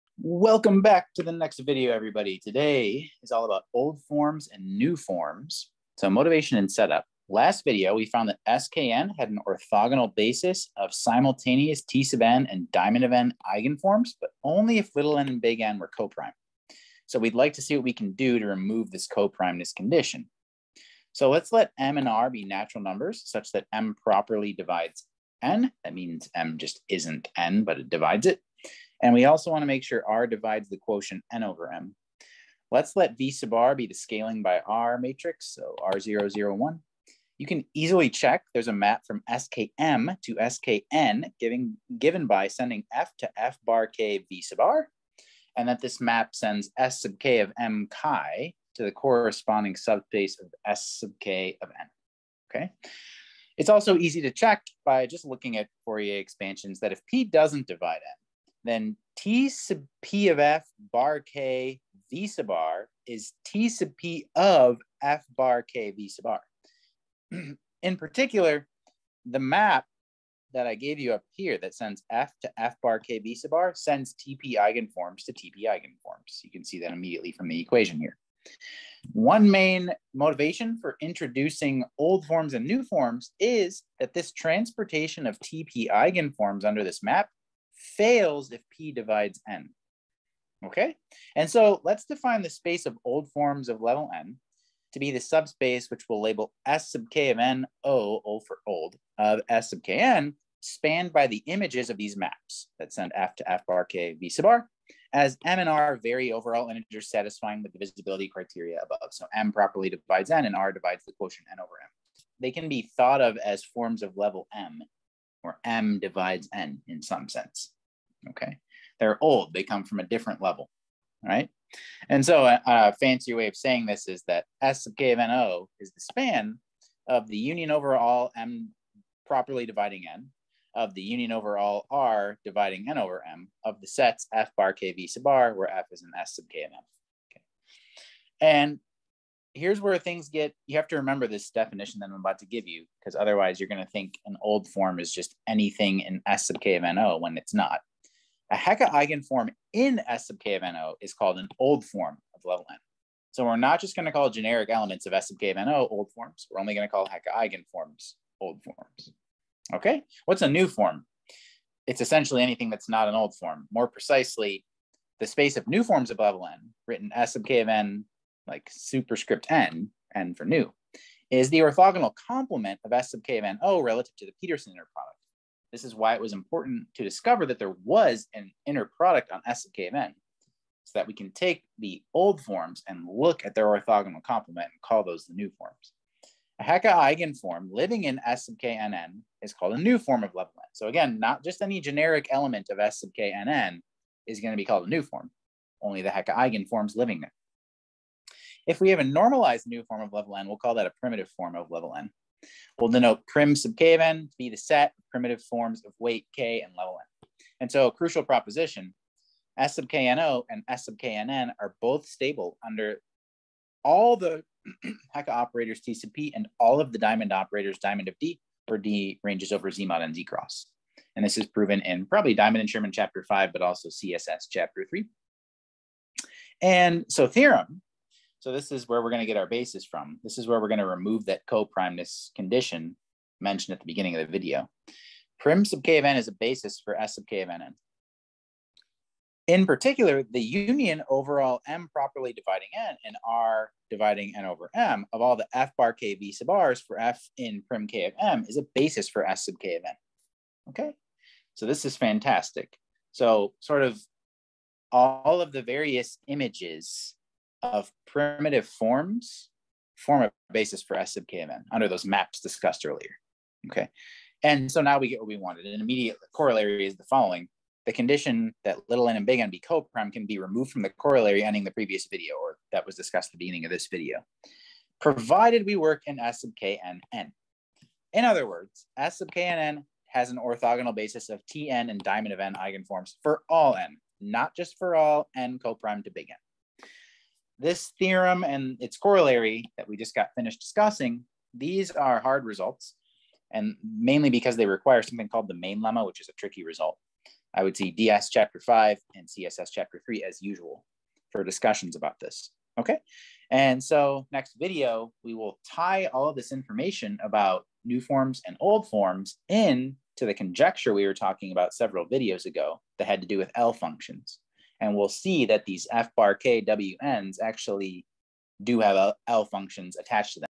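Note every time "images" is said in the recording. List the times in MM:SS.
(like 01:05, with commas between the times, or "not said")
01:41, 04:16.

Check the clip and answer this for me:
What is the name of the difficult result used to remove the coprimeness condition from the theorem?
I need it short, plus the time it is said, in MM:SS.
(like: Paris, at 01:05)
The main lemma, at 04:55.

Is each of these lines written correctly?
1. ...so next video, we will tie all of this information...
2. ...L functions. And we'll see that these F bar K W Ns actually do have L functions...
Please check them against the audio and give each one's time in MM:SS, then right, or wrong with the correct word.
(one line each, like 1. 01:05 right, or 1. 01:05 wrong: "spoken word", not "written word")
1. 05:03 right
2. 05:13 right.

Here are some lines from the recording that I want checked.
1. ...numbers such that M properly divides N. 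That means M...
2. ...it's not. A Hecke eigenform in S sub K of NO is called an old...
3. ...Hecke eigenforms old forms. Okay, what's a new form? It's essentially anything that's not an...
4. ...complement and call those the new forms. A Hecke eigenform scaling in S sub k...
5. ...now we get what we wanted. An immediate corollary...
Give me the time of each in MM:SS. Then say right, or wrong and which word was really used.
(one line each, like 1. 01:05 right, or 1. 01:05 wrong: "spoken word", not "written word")
1. 00:22 right
2. 02:27 right
3. 02:37 right
4. 03:04 wrong: "living", not "scaling"
5. 04:24 right.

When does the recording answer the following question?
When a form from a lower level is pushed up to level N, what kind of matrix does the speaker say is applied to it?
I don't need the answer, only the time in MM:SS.
00:33.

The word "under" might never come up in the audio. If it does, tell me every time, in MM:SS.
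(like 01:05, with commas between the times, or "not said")
01:26, 03:32, 04:21.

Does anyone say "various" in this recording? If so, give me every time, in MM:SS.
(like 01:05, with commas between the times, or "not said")
04:15.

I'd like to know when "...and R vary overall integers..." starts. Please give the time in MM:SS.
01:45.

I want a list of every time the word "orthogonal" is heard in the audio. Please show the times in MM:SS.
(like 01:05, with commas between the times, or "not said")
00:09, 02:51, 03:03, 04:40.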